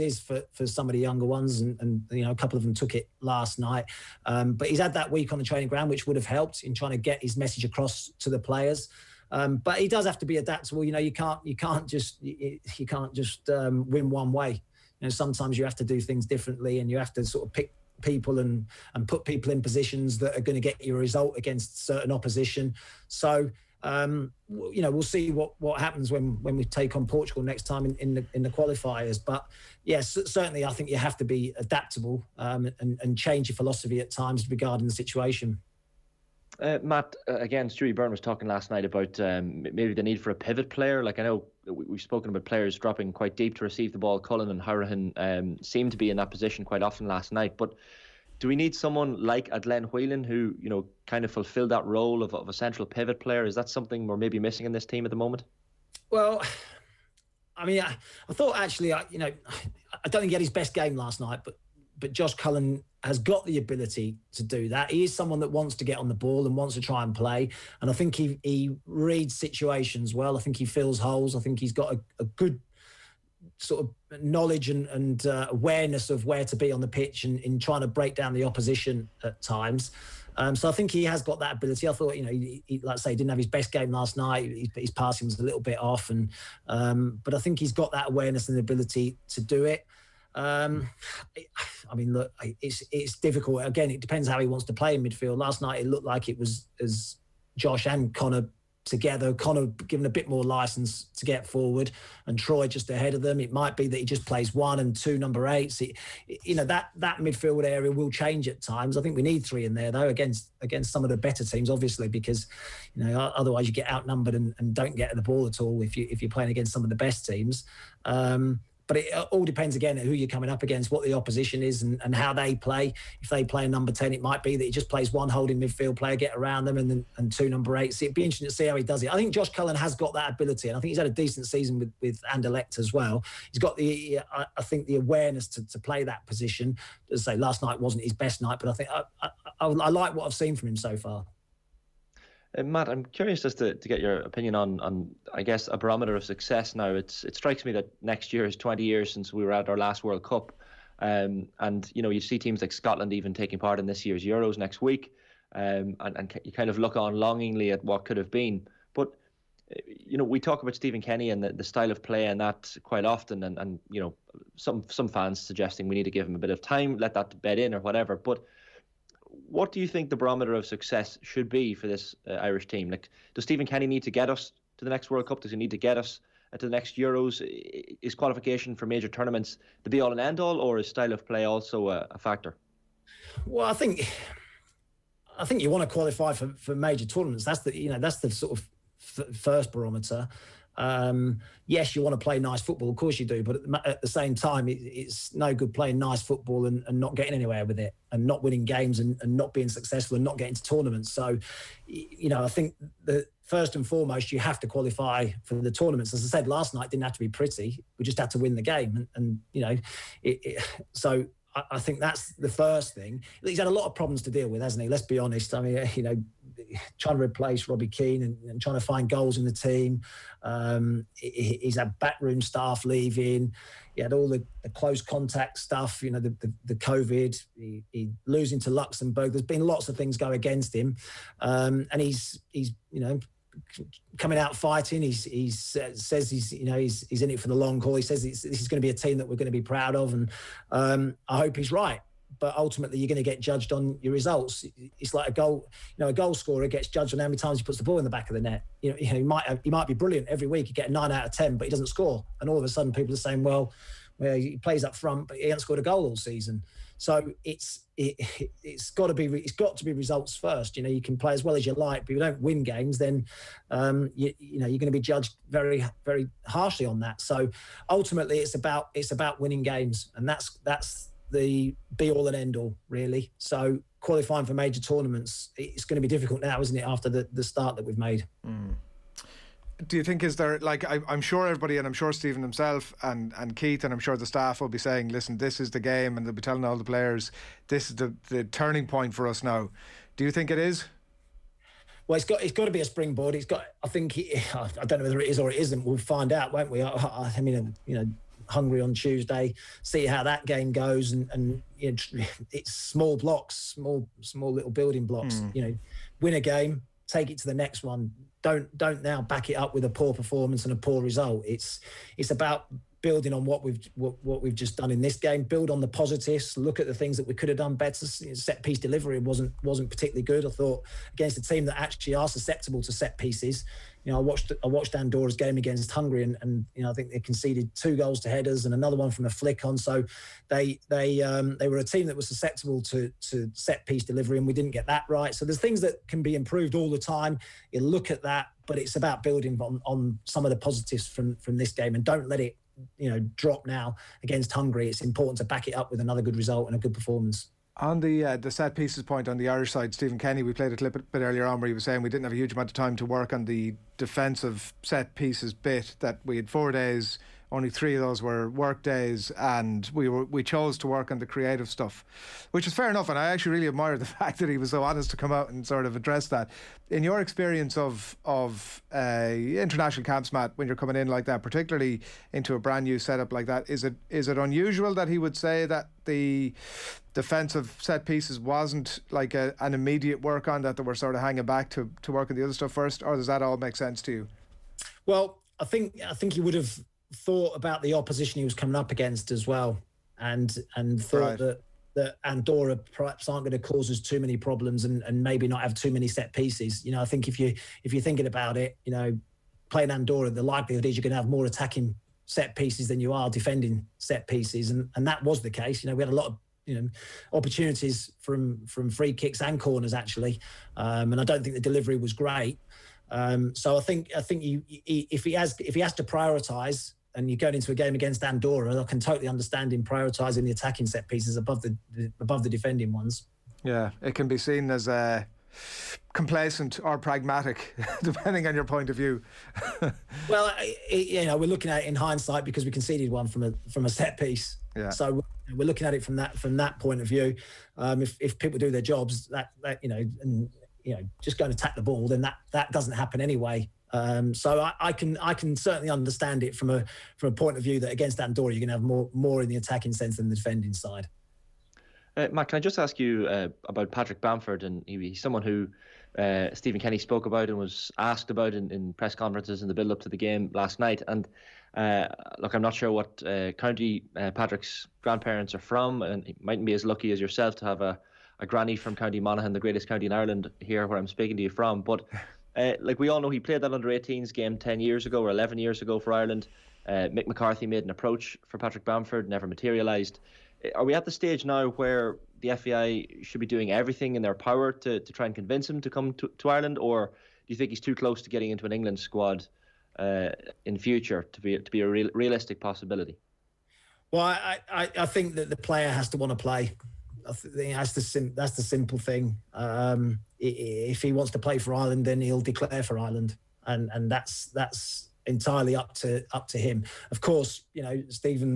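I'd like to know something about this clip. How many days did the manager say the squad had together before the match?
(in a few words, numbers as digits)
4.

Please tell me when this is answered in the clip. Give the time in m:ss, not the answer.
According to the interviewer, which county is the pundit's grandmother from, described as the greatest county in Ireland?
7:48.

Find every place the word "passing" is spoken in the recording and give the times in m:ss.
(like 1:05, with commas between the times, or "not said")
1:24.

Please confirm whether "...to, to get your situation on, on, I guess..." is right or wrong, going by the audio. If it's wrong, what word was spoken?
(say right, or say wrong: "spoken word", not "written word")
wrong: "opinion", not "situation".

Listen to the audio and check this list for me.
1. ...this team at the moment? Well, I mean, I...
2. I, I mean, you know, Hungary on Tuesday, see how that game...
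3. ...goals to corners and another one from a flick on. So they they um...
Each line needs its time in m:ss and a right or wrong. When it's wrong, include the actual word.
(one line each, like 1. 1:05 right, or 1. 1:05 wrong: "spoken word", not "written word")
1. 0:54 right
2. 4:56 right
3. 5:27 wrong: "headers", not "corners".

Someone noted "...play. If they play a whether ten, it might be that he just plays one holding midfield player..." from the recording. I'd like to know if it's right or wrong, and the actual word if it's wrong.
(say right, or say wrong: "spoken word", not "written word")
wrong: "number", not "whether".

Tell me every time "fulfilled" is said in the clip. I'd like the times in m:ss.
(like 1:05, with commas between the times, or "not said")
0:51.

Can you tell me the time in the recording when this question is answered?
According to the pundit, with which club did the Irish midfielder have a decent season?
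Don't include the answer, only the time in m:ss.
2:12.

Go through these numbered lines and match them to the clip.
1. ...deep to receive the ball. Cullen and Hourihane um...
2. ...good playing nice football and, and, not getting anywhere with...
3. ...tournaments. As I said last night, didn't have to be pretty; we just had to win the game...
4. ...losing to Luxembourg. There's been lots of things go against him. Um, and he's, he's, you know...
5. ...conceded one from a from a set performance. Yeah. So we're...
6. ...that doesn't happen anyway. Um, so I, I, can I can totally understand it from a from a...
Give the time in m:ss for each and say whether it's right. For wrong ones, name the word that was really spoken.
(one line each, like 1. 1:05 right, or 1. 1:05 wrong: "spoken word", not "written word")
1. 0:43 right
2. 3:15 right
3. 3:25 right
4. 3:48 right
5. 7:12 wrong: "piece", not "performance"
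6. 7:22 wrong: "certainly", not "totally".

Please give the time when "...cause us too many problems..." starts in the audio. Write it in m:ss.
6:33.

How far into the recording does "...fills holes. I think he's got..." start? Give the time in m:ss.
1:10.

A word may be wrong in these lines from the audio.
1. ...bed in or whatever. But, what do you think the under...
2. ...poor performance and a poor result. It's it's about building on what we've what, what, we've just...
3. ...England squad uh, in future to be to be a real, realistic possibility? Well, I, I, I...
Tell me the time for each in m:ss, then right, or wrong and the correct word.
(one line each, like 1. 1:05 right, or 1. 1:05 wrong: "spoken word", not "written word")
1. 2:47 wrong: "barometer", not "under"
2. 5:09 right
3. 8:08 right.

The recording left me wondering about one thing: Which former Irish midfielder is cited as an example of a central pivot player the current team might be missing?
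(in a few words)
Glenn Whelan.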